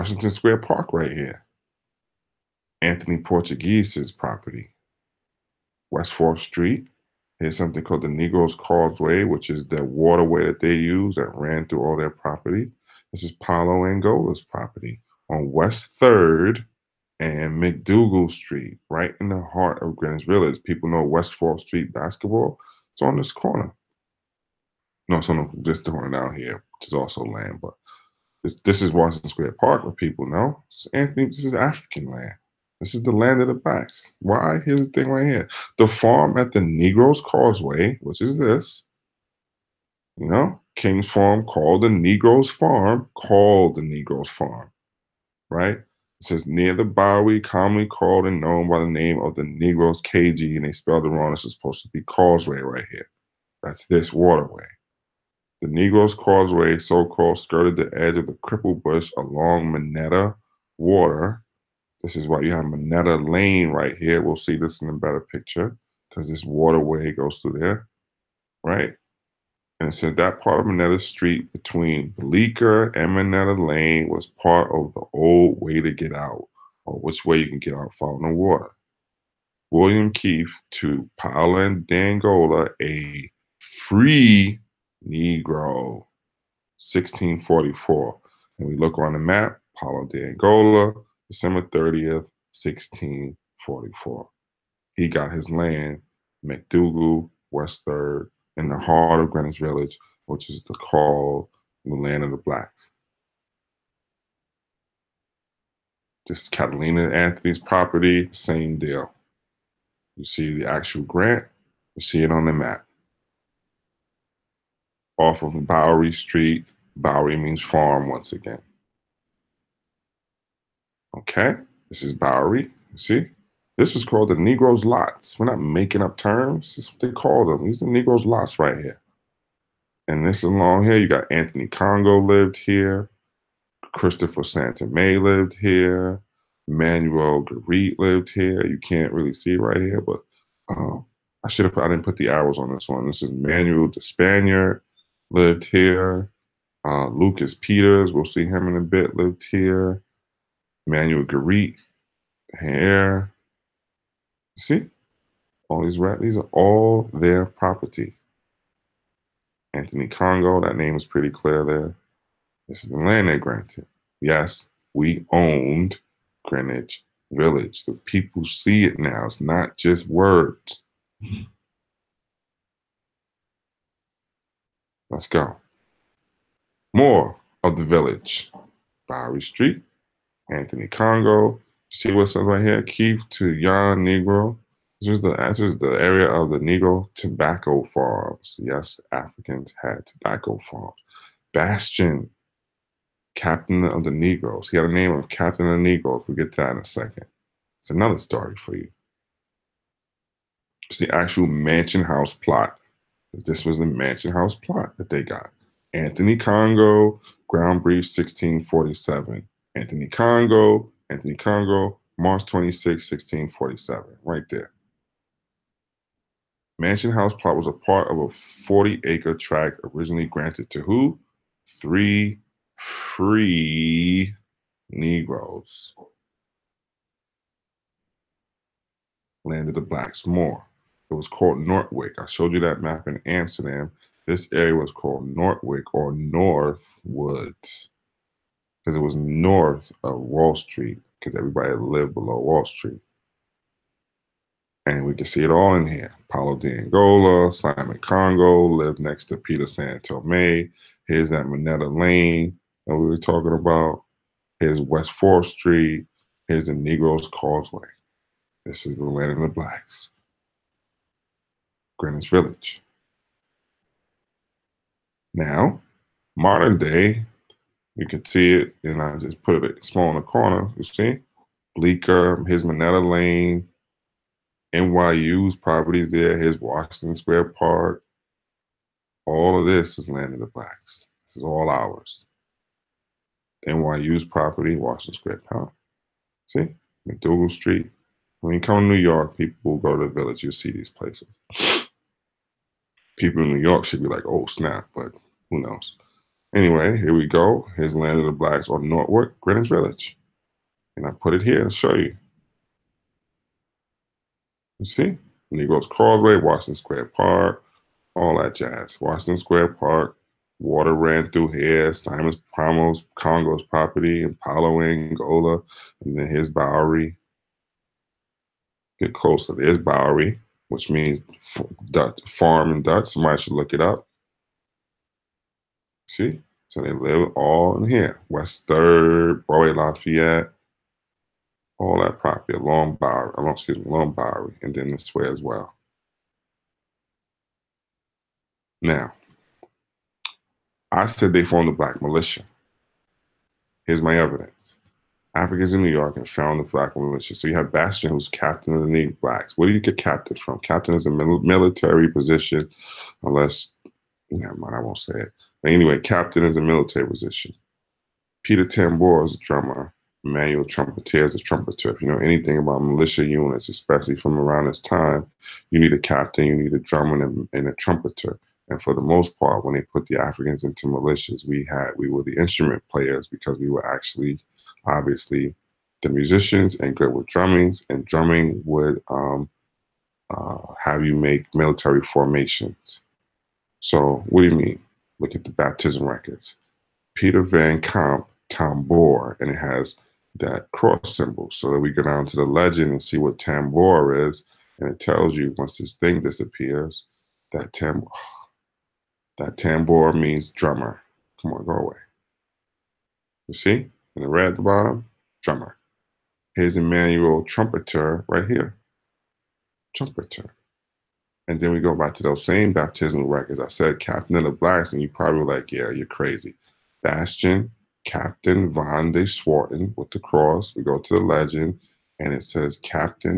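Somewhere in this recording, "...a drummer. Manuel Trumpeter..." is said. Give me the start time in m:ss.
5:59.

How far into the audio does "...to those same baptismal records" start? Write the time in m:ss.
6:52.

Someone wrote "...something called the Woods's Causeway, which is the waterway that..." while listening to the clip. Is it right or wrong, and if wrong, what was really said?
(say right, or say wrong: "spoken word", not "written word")
wrong: "Negro", not "Woods".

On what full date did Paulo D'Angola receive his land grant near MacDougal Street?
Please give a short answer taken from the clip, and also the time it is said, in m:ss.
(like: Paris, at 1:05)
December 30th, 1644, at 1:31.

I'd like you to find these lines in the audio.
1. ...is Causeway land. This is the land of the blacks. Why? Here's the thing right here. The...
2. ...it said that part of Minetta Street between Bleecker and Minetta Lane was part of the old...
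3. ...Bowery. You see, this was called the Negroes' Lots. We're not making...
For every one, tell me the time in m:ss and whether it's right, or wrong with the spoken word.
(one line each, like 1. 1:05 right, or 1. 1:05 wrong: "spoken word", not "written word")
1. 0:31 wrong: "African", not "Causeway"
2. 1:09 right
3. 2:02 right.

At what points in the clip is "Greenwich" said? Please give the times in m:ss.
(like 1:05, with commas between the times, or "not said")
0:19, 1:39, 2:46, 4:21, 4:59.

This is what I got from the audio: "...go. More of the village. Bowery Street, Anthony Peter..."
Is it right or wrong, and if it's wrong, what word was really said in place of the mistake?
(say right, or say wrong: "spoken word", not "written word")
wrong: "Congo", not "Peter".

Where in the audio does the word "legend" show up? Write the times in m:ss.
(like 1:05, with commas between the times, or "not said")
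6:32, 7:01.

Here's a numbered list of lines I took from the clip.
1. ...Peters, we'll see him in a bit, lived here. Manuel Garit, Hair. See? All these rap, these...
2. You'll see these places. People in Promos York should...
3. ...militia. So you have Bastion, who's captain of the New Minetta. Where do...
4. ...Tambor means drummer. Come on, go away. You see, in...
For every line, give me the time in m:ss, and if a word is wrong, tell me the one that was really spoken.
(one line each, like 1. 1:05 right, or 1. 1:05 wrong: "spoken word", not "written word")
1. 2:27 right
2. 4:50 wrong: "New", not "Promos"
3. 5:46 wrong: "Blacks", not "Minetta"
4. 6:39 right.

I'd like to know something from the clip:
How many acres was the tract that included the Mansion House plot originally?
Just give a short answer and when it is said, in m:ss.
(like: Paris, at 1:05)
40, at 3:38.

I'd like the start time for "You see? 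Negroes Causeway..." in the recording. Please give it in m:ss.
5:04.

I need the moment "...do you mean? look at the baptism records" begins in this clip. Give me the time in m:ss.
6:24.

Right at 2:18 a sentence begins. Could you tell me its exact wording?
You can't really see right here, but um, I should have.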